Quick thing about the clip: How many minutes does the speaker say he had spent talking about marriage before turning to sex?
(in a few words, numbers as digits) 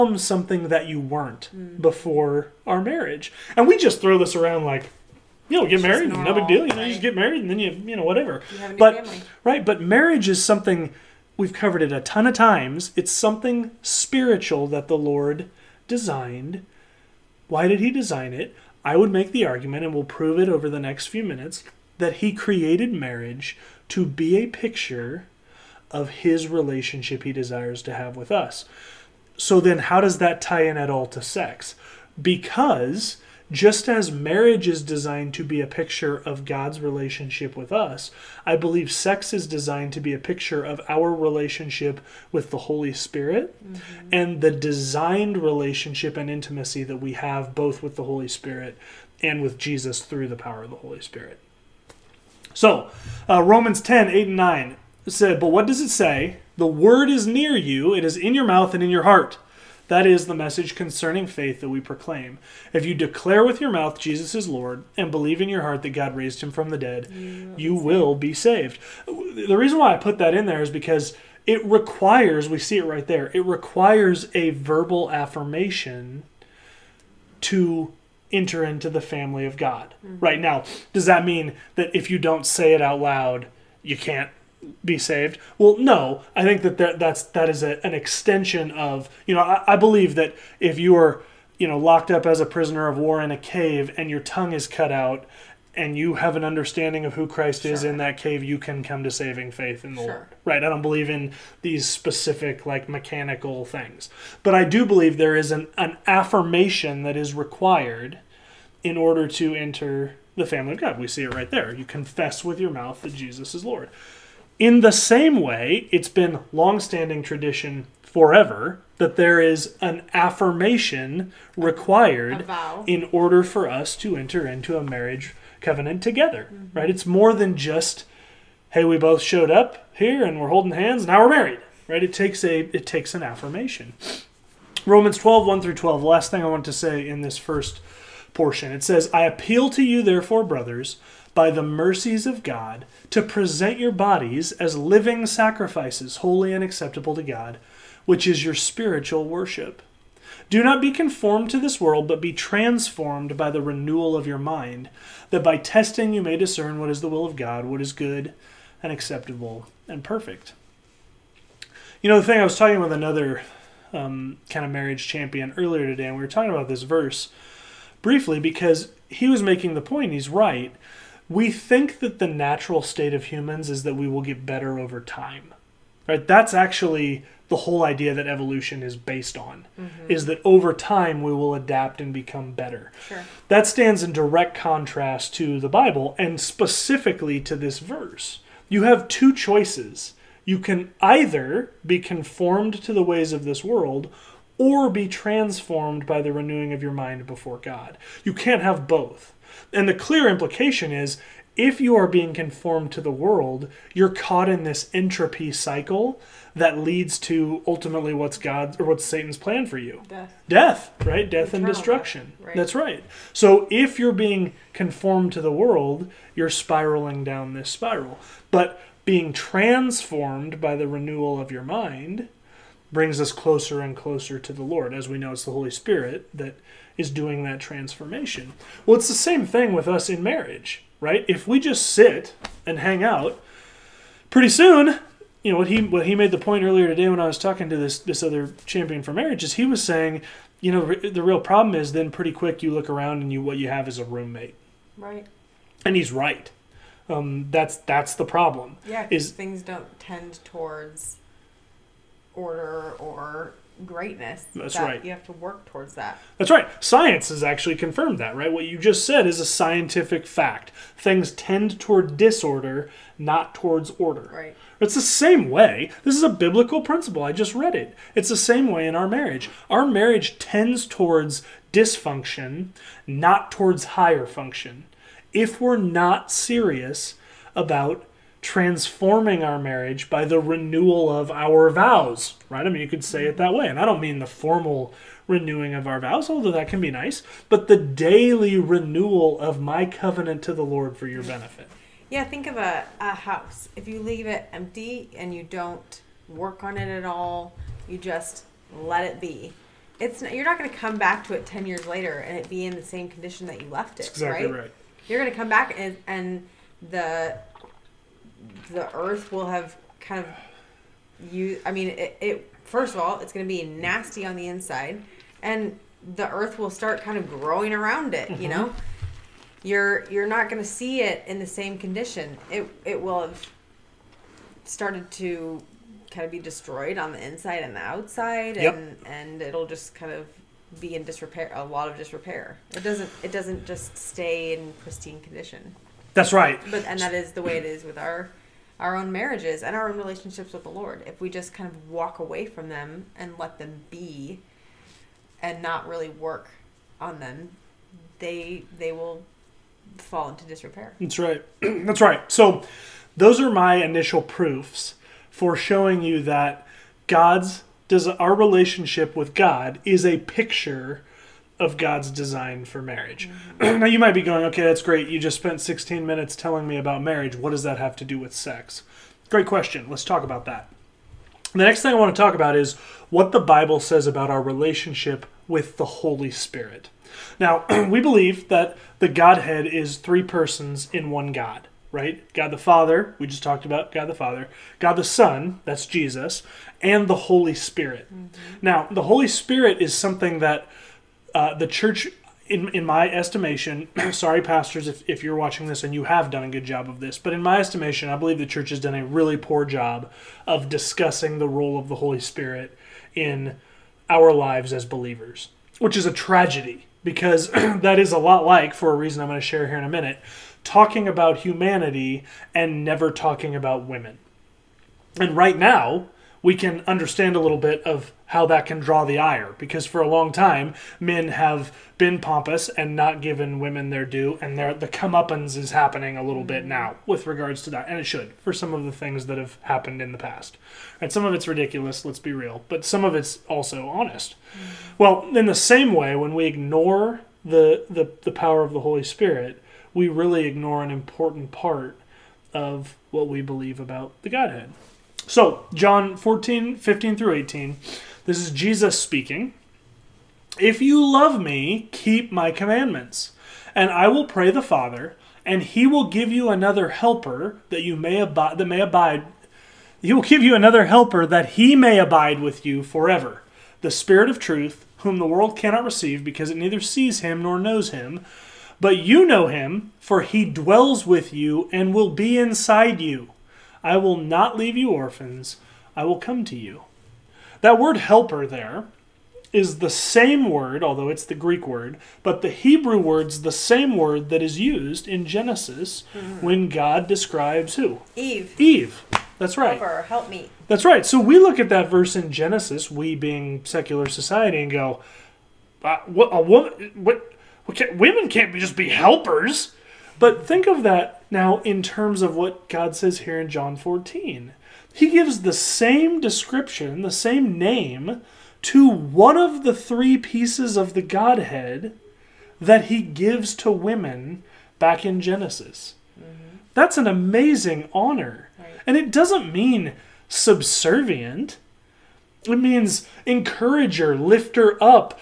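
16.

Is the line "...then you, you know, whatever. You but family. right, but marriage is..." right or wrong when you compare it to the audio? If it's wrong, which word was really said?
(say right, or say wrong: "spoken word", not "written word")
right.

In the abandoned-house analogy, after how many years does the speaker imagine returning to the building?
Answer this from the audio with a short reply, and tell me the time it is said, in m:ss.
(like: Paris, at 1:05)
10 years, at 5:01.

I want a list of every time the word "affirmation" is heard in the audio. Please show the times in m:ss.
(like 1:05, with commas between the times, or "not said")
1:15, 1:46, 2:00, 2:13.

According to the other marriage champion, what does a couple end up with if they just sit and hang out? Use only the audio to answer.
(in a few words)
A roommate.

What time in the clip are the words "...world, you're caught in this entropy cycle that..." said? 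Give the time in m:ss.
3:23.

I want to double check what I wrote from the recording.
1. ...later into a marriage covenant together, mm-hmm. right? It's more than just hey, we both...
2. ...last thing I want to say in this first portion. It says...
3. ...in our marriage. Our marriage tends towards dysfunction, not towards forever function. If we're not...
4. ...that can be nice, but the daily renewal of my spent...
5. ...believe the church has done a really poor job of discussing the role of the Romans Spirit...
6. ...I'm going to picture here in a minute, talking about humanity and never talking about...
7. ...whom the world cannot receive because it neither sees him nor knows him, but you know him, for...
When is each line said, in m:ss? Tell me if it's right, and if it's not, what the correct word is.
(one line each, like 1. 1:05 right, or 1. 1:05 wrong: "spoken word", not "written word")
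1. 2:04 wrong: "enter", not "later"
2. 2:16 right
3. 4:28 wrong: "higher", not "forever"
4. 4:46 wrong: "covenant", not "spent"
5. 6:38 wrong: "Holy", not "Romans"
6. 6:49 wrong: "share", not "picture"
7. 7:44 right.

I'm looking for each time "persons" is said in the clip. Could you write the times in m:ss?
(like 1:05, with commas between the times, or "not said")
6:20.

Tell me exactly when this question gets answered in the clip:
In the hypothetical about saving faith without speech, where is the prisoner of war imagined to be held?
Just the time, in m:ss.
1:33.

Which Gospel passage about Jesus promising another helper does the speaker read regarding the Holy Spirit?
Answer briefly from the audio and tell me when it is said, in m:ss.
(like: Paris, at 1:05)
John 14:15-18, at 7:25.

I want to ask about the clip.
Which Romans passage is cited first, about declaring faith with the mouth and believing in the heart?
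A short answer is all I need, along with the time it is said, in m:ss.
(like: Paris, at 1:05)
Romans 10:8-9, at 0:53.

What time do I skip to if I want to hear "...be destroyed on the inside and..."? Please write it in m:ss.
5:26.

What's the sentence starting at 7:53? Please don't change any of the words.
I will not leave you orphans, I will come to you.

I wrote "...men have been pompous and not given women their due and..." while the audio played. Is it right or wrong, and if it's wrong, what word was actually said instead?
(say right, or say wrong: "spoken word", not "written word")
right.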